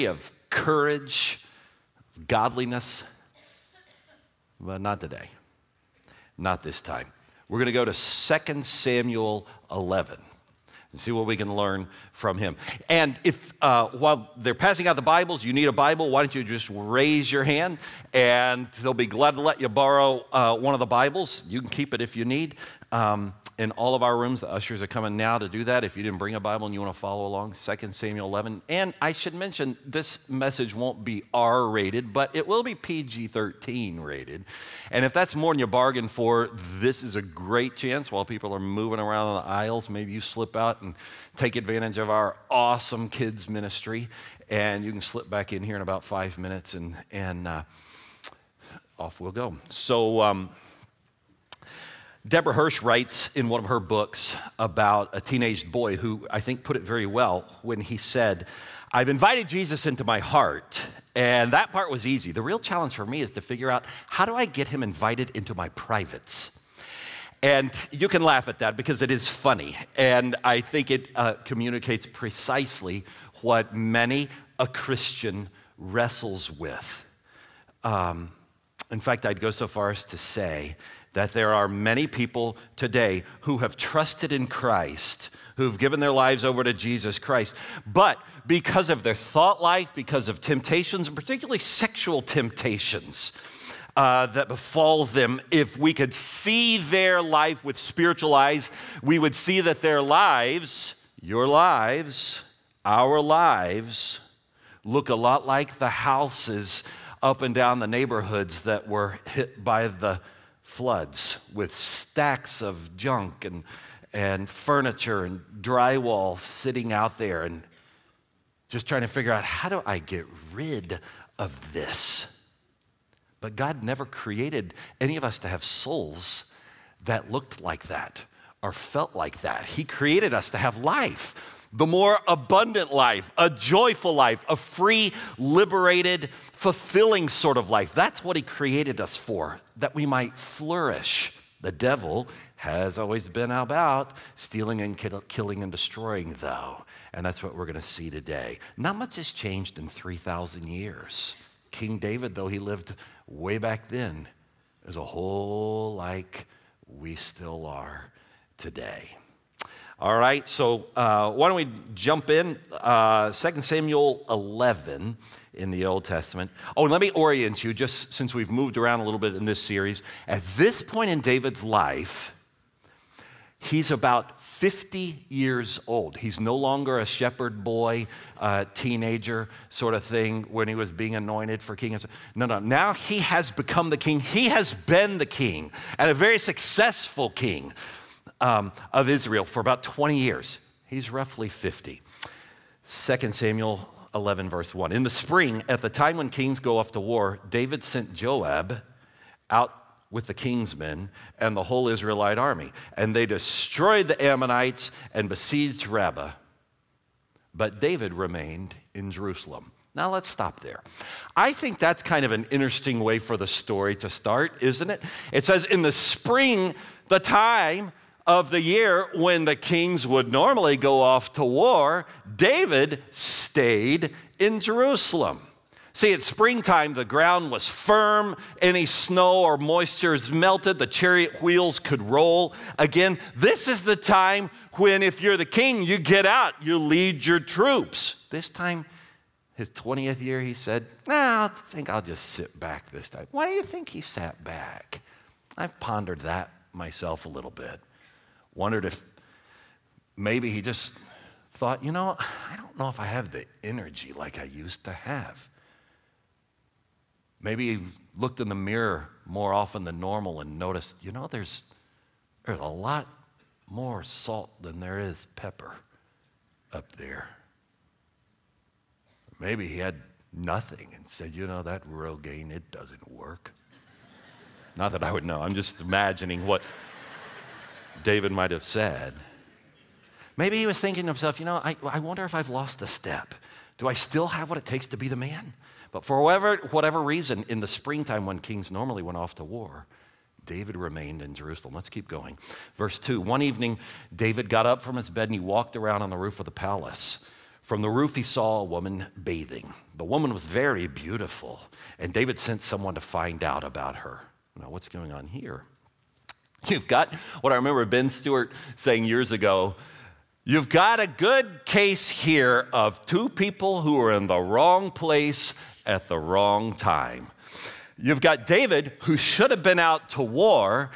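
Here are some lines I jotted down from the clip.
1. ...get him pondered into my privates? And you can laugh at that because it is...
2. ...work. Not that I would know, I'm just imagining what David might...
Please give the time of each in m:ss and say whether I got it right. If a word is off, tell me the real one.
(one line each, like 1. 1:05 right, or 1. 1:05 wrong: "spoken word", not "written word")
1. 1:04 wrong: "invited", not "pondered"
2. 4:33 right.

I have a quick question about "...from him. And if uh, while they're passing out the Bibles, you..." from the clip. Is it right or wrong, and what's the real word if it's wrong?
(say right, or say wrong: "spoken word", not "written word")
right.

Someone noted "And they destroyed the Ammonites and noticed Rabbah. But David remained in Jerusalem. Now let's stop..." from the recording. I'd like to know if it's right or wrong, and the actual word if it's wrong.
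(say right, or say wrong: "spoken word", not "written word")
wrong: "besieged", not "noticed".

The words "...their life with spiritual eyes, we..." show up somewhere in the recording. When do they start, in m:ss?
1:36.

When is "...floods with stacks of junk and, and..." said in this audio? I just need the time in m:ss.
1:50.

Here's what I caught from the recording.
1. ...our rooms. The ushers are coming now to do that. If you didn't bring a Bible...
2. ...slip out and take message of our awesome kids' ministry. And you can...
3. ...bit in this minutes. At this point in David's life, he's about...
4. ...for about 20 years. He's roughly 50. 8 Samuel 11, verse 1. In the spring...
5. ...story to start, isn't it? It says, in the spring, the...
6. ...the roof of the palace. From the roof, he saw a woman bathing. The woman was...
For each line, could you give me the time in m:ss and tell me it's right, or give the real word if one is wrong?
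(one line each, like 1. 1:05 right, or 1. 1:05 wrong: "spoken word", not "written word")
1. 0:24 right
2. 0:40 wrong: "advantage", not "message"
3. 2:49 wrong: "series", not "minutes"
4. 3:09 wrong: "2", not "8"
5. 3:33 right
6. 4:56 right.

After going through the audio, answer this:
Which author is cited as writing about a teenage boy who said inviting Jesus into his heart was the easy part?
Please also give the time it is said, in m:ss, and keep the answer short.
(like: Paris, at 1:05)
Debra Hirsch, at 0:52.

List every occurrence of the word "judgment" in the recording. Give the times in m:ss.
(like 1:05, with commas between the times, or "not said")
not said.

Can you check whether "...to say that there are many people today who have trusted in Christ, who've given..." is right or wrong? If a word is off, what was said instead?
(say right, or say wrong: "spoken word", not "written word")
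right.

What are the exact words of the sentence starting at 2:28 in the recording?
Not much has changed in 3,000 years.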